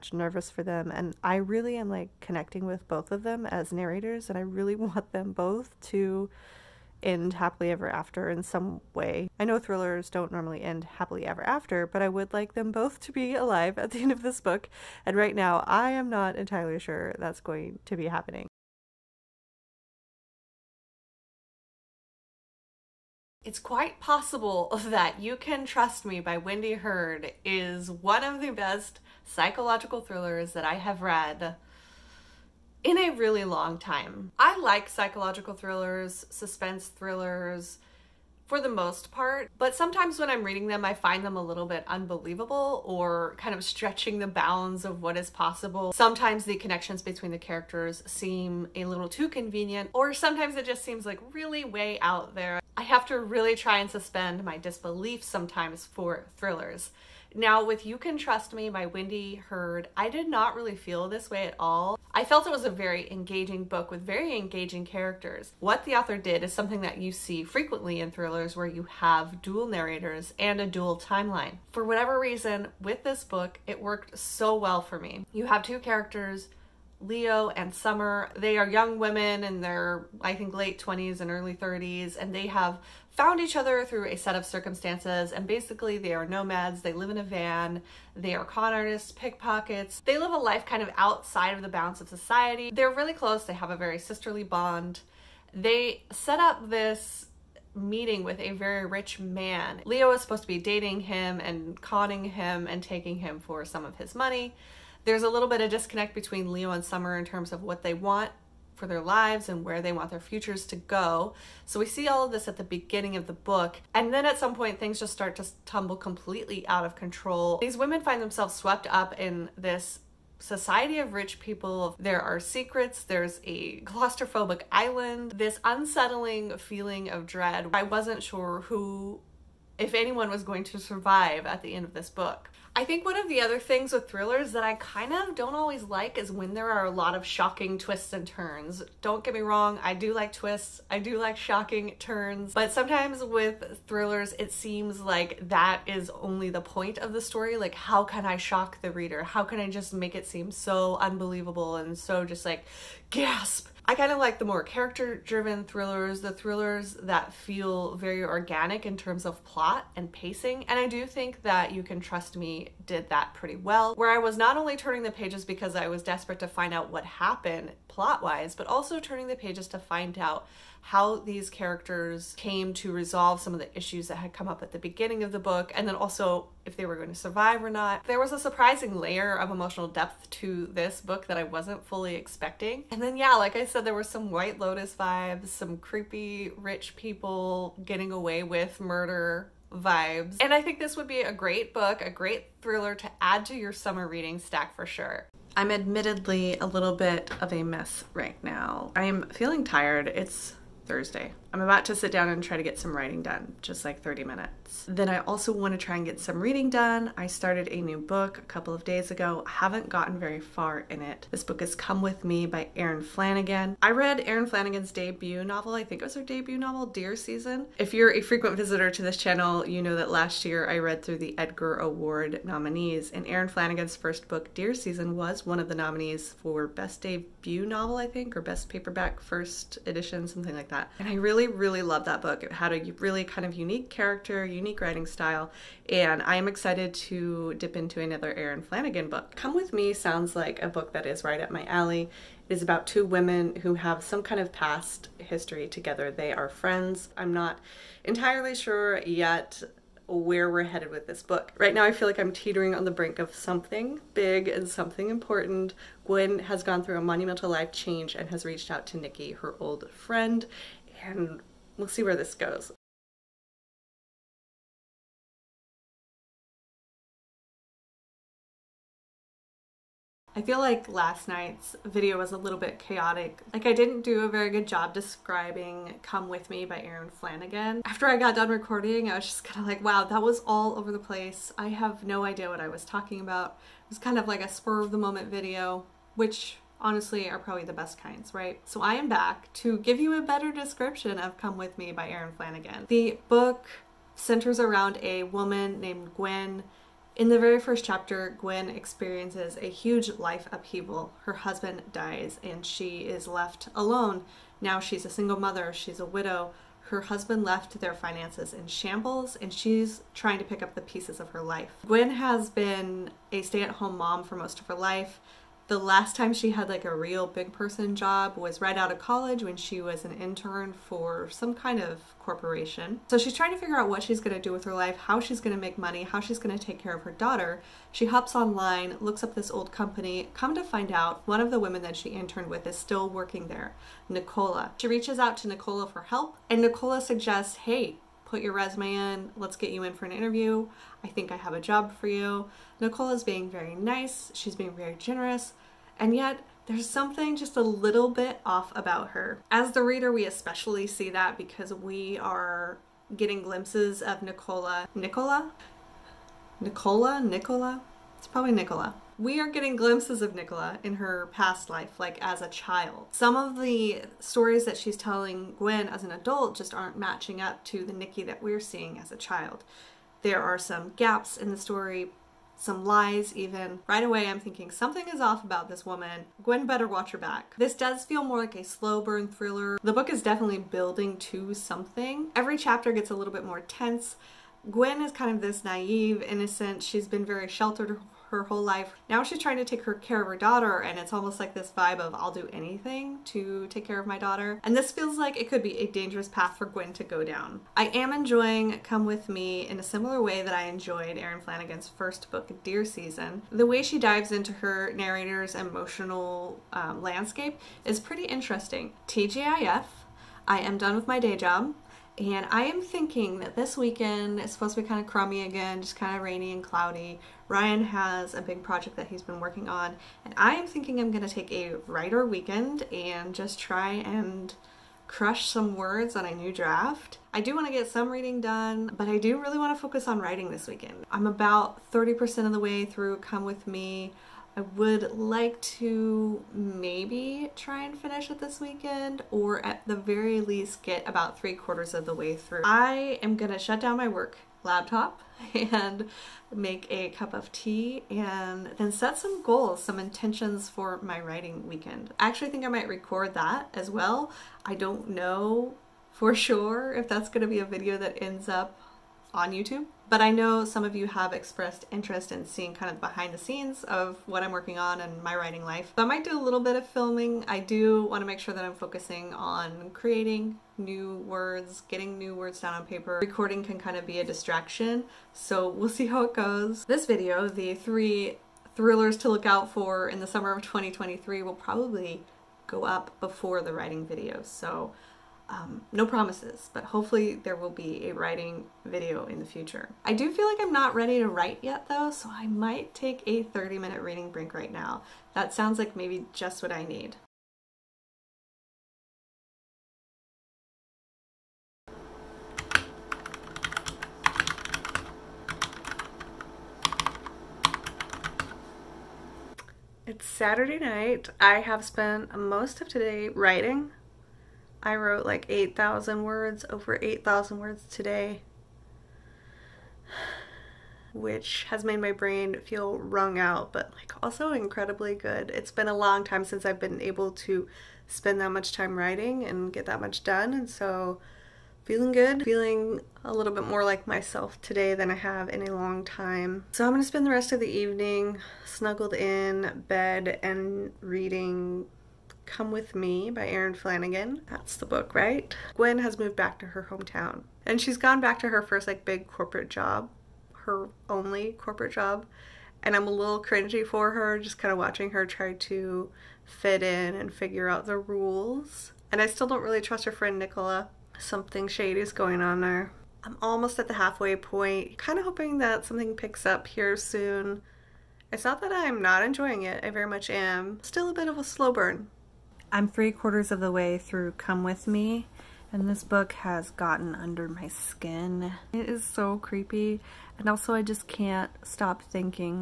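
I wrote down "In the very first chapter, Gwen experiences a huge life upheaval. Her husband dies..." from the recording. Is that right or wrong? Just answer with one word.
right.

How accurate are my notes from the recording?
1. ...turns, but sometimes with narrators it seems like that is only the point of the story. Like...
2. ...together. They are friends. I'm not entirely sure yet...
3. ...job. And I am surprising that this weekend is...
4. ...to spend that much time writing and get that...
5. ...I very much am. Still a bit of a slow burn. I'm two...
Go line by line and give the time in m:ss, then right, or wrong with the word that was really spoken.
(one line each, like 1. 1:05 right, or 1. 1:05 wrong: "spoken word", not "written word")
1. 2:21 wrong: "thrillers", not "narrators"
2. 4:05 right
3. 6:51 wrong: "thinking", not "surprising"
4. 8:47 right
5. 9:29 wrong: "three", not "two".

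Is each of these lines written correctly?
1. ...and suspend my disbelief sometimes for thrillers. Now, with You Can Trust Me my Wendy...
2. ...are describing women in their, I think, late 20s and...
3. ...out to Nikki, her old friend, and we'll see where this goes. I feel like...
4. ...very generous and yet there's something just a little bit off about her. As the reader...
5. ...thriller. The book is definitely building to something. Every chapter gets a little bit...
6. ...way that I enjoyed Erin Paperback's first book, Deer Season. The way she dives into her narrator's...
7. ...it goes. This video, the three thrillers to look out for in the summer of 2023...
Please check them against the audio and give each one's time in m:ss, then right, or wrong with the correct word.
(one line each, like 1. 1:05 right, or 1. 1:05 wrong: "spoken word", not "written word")
1. 0:53 right
2. 1:18 wrong: "young", not "describing"
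3. 4:18 right
4. 5:44 right
5. 6:19 right
6. 6:40 wrong: "Flanagan", not "Paperback"
7. 7:56 right.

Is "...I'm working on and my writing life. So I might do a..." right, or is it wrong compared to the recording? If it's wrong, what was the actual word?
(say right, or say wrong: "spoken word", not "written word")
right.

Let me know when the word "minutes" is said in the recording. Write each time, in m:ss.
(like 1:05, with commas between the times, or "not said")
3:24, 8:13.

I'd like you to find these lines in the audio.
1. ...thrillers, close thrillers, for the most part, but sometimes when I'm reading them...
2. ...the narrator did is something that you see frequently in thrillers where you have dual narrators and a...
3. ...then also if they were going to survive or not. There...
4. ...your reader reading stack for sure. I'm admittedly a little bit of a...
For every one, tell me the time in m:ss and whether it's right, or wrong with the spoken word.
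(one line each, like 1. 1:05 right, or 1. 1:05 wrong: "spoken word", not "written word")
1. 0:35 wrong: "suspense", not "close"
2. 1:05 wrong: "author", not "narrator"
3. 2:55 right
4. 3:13 wrong: "summer", not "reader".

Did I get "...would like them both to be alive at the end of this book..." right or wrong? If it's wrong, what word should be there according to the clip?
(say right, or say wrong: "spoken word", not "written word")
right.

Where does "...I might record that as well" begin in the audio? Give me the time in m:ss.
7:32.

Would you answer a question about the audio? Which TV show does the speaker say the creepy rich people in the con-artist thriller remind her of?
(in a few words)
White Lotus.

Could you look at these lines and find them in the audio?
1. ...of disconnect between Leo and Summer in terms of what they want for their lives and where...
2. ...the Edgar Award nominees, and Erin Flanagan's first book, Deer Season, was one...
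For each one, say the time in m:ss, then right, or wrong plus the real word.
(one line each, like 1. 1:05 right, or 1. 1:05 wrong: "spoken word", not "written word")
1. 1:45 right
2. 3:41 right.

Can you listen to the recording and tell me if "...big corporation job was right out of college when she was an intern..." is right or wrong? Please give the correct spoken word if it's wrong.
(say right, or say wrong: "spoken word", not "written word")
wrong: "person", not "corporation".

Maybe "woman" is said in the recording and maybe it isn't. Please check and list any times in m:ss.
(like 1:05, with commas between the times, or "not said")
4:55, 6:15.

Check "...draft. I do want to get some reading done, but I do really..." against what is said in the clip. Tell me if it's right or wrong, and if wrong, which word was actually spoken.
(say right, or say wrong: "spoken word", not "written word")
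right.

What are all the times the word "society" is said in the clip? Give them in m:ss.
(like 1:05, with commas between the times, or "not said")
1:32, 2:00.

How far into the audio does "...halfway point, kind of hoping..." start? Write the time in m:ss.
9:23.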